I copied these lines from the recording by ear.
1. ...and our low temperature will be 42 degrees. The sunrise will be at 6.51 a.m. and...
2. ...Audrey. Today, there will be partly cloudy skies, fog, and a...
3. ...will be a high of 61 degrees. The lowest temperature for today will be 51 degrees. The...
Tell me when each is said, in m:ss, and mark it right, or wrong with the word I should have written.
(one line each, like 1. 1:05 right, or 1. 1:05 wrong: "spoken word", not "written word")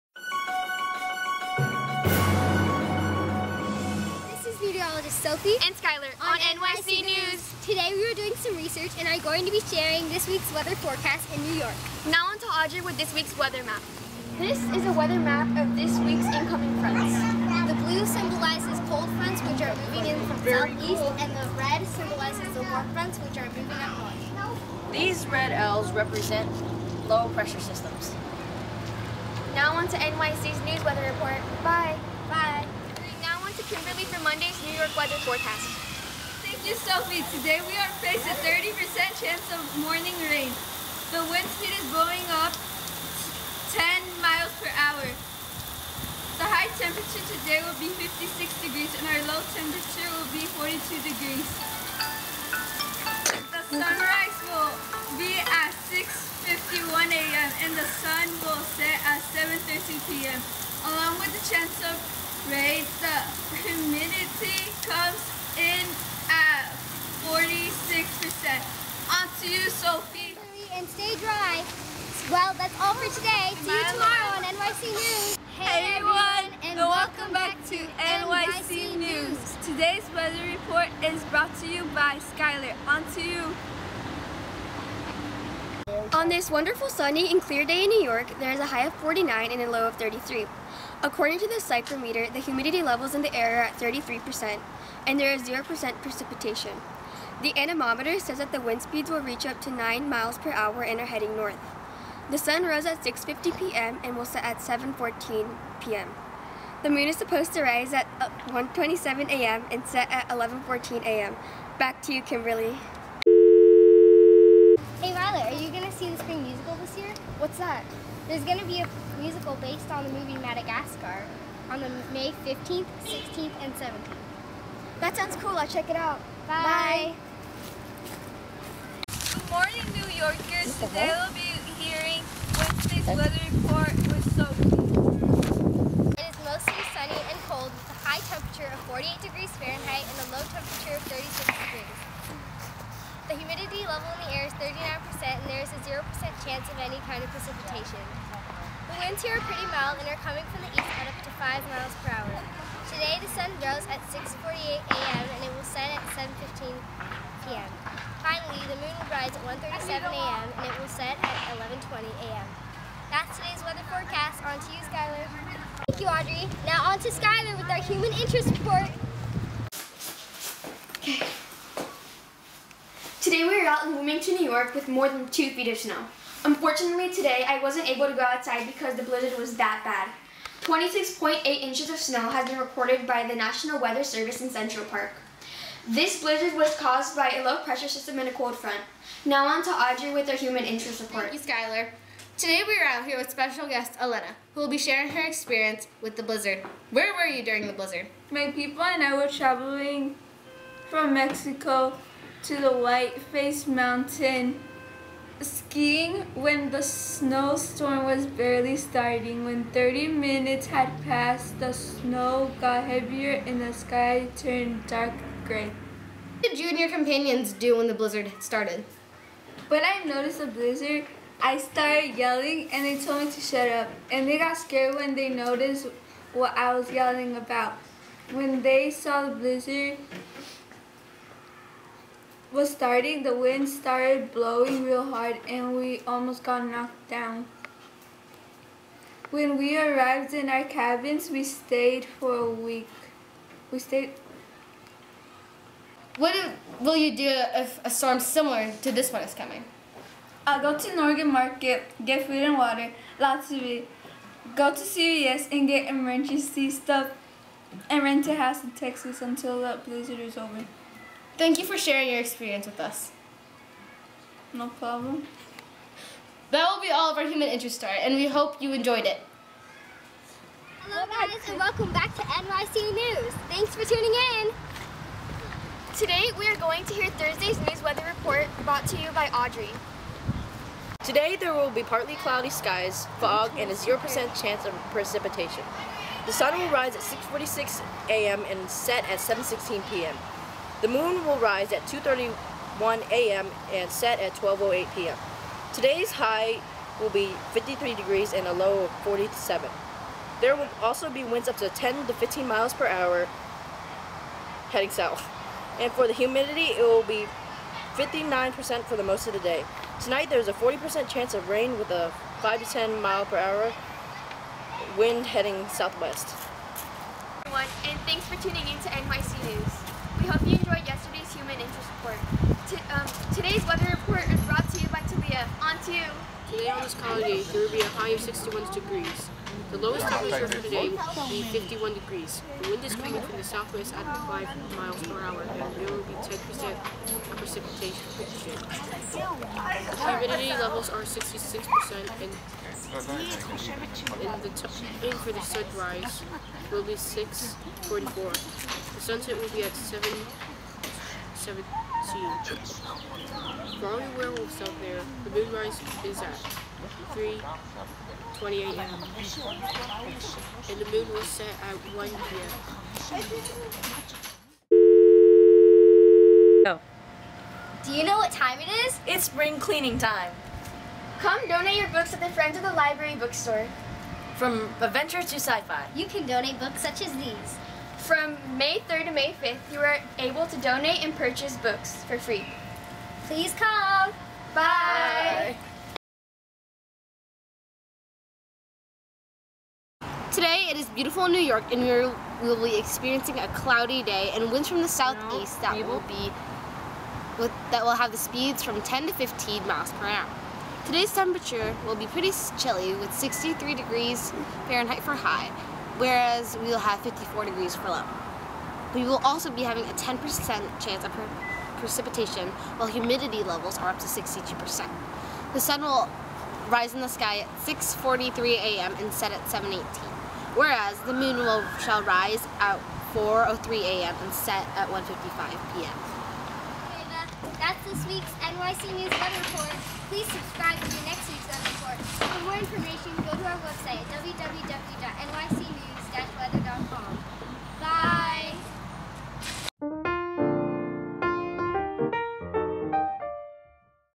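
1. 0:49 right
2. 4:39 right
3. 5:27 right.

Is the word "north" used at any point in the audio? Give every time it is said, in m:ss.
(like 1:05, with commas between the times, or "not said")
0:24, 1:41.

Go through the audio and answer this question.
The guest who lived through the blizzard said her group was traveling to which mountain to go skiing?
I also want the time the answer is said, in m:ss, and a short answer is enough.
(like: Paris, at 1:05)
Whiteface Mountain, at 3:22.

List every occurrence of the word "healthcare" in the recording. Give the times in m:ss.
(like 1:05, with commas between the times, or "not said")
not said.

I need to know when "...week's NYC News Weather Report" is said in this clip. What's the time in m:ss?
7:08.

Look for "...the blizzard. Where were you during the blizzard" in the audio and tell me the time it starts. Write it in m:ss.
3:16.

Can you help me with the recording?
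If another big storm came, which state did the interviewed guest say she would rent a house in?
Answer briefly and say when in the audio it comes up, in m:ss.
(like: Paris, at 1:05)
Texas, at 4:18.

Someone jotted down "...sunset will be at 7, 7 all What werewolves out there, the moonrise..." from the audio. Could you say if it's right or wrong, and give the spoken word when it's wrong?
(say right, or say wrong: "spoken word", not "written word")
wrong: "Growing", not "What".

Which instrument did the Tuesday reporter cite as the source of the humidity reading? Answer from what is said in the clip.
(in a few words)
Psychrometer.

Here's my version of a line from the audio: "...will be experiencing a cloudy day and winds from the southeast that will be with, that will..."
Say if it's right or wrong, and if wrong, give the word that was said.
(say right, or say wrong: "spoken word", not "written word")
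right.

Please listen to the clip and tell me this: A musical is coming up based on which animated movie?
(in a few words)
Madagascar.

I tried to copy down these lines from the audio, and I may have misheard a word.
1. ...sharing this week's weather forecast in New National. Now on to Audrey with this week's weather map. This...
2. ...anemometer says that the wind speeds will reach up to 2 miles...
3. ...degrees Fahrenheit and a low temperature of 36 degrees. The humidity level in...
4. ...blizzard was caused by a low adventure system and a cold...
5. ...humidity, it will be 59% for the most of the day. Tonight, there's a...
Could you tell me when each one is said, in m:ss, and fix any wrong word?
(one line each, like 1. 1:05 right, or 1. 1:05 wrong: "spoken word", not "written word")
1. 0:09 wrong: "York", not "National"
2. 1:37 wrong: "9", not "2"
3. 2:19 right
4. 3:06 wrong: "pressure", not "adventure"
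5. 5:06 right.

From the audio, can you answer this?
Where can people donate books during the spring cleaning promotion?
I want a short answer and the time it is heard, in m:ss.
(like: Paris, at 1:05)
Friends of the Library bookstore, at 6:12.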